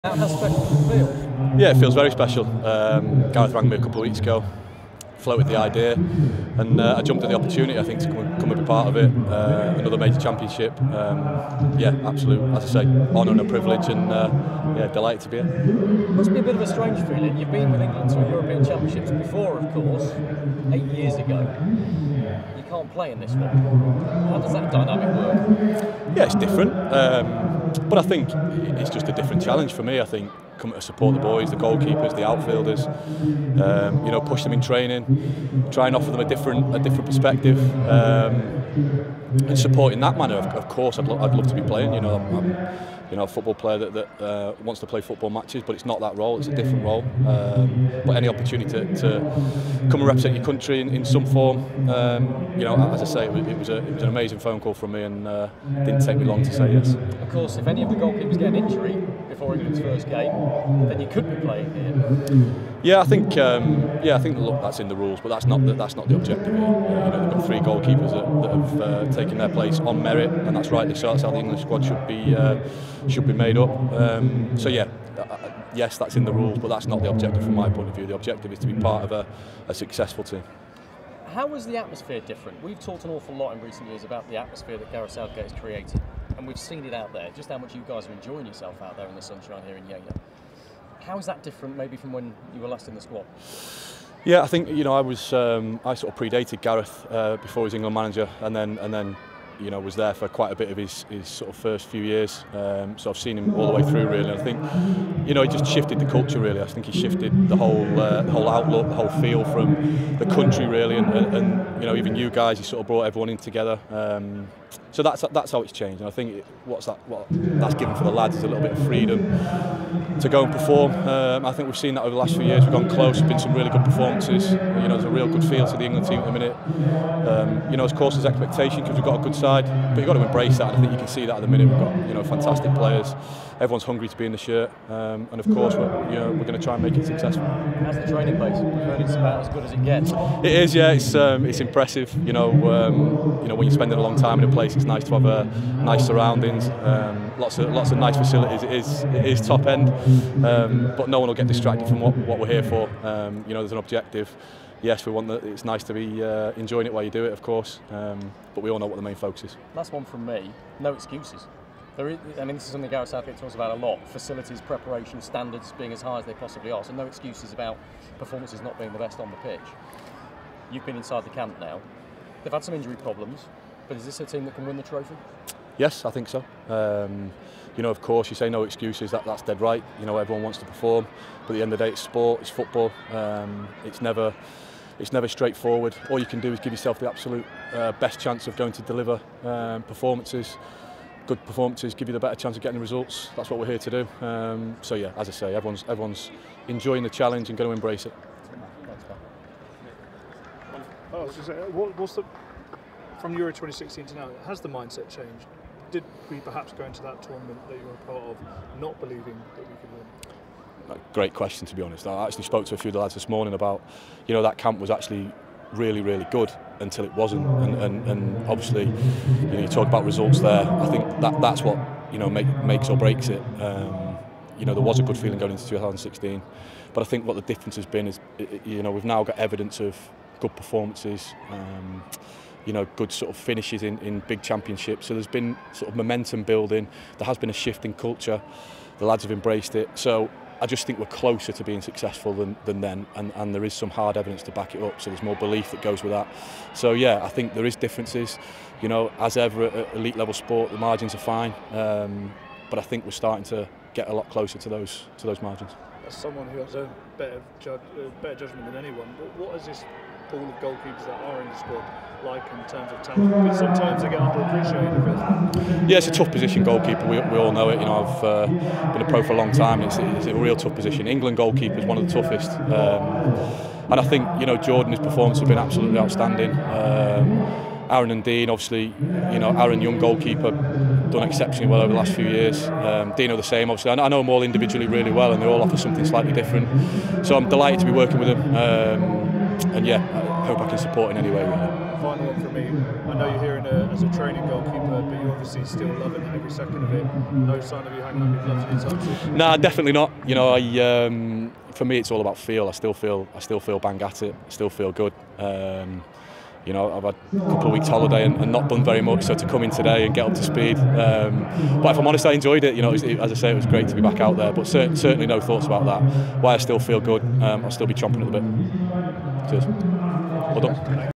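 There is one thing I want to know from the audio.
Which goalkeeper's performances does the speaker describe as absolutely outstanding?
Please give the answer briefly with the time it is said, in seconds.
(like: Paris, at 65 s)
Jordan, at 274 s.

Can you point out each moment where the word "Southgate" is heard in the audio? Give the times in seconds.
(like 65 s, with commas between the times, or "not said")
85 s, 163 s.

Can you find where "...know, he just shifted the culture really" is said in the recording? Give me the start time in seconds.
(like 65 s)
105 s.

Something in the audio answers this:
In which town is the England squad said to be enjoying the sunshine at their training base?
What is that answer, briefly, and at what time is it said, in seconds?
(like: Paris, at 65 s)
Yeovil, at 89 s.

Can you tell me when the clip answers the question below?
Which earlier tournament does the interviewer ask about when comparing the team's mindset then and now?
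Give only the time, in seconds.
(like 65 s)
203 s.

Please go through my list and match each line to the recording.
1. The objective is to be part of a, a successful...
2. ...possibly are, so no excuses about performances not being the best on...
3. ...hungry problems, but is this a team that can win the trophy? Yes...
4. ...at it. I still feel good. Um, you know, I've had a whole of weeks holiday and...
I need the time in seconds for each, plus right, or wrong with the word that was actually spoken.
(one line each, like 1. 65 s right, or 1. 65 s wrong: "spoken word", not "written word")
1. 78 s right
2. 166 s right
3. 172 s wrong: "injury", not "hungry"
4. 304 s wrong: "couple", not "whole".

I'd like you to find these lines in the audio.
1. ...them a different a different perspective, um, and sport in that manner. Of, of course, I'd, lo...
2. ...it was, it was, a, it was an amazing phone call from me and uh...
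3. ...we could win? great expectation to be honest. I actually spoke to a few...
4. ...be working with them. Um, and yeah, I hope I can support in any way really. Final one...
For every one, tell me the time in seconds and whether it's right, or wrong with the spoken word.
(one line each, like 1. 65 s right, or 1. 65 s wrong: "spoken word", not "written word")
1. 36 s wrong: "support", not "sport"
2. 53 s right
3. 209 s wrong: "question", not "expectation"
4. 287 s right.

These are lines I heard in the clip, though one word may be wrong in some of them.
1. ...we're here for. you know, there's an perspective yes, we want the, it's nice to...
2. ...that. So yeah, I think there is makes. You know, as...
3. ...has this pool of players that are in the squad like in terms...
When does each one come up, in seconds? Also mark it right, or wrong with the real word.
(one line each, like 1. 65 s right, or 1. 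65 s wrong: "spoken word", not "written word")
1. 152 s wrong: "objective", not "perspective"
2. 246 s wrong: "differences", not "makes"
3. 259 s wrong: "goalkeepers", not "players".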